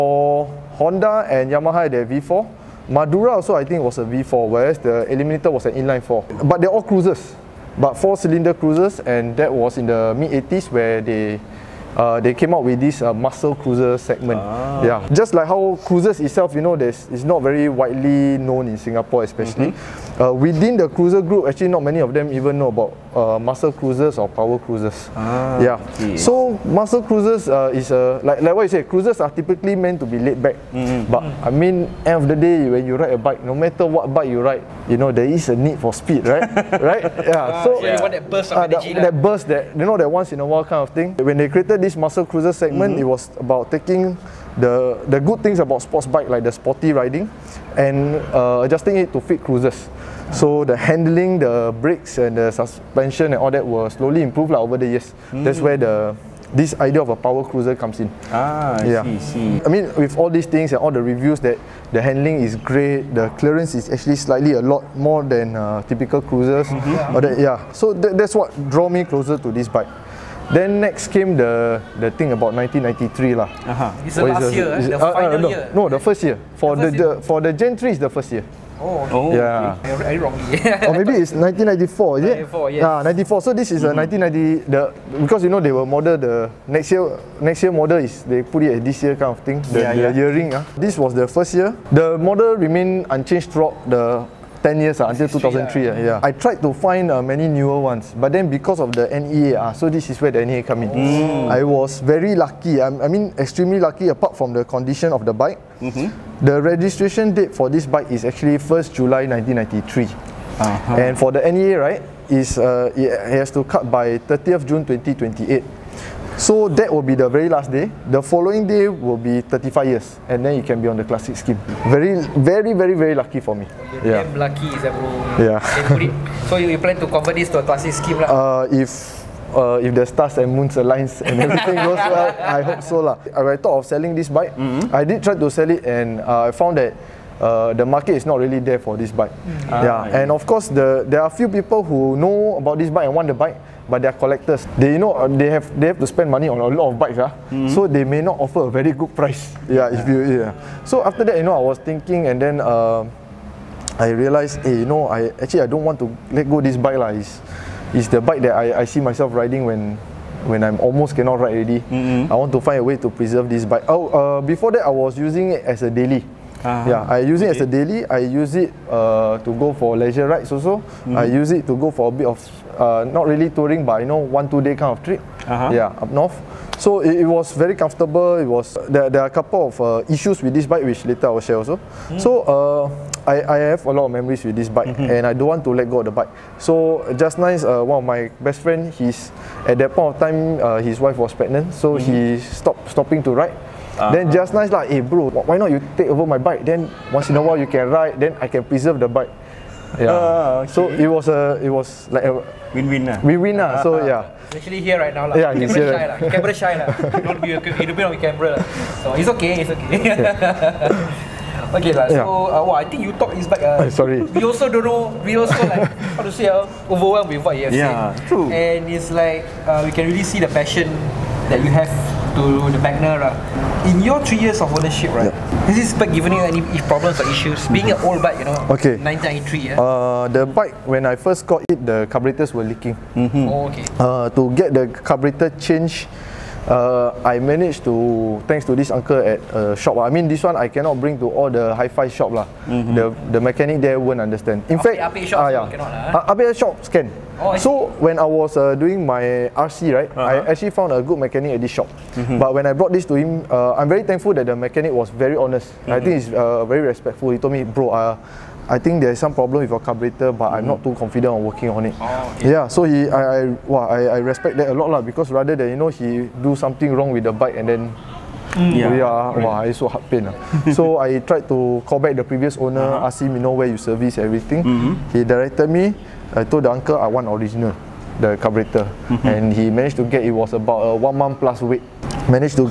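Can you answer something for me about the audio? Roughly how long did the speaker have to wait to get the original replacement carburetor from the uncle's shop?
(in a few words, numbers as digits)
one month plus.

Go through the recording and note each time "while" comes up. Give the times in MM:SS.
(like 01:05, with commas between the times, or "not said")
00:40, 03:17.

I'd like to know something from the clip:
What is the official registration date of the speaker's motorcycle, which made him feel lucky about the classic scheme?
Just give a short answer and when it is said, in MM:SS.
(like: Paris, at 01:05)
1st July 1993, at 01:48.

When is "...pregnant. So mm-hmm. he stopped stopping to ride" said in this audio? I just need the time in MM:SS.
03:11.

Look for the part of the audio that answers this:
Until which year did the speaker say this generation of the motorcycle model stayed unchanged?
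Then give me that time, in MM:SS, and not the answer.
01:35.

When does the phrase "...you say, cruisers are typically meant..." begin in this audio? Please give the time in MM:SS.
00:28.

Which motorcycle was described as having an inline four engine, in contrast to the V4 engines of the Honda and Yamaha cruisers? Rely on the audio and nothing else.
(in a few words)
Eliminator.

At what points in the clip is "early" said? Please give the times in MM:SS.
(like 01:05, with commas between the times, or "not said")
not said.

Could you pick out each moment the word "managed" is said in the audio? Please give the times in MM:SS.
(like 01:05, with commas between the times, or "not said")
03:57, 04:39.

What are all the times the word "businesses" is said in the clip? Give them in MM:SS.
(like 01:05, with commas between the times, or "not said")
not said.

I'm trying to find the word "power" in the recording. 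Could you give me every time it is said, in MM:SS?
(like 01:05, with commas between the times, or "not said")
00:24, 00:57.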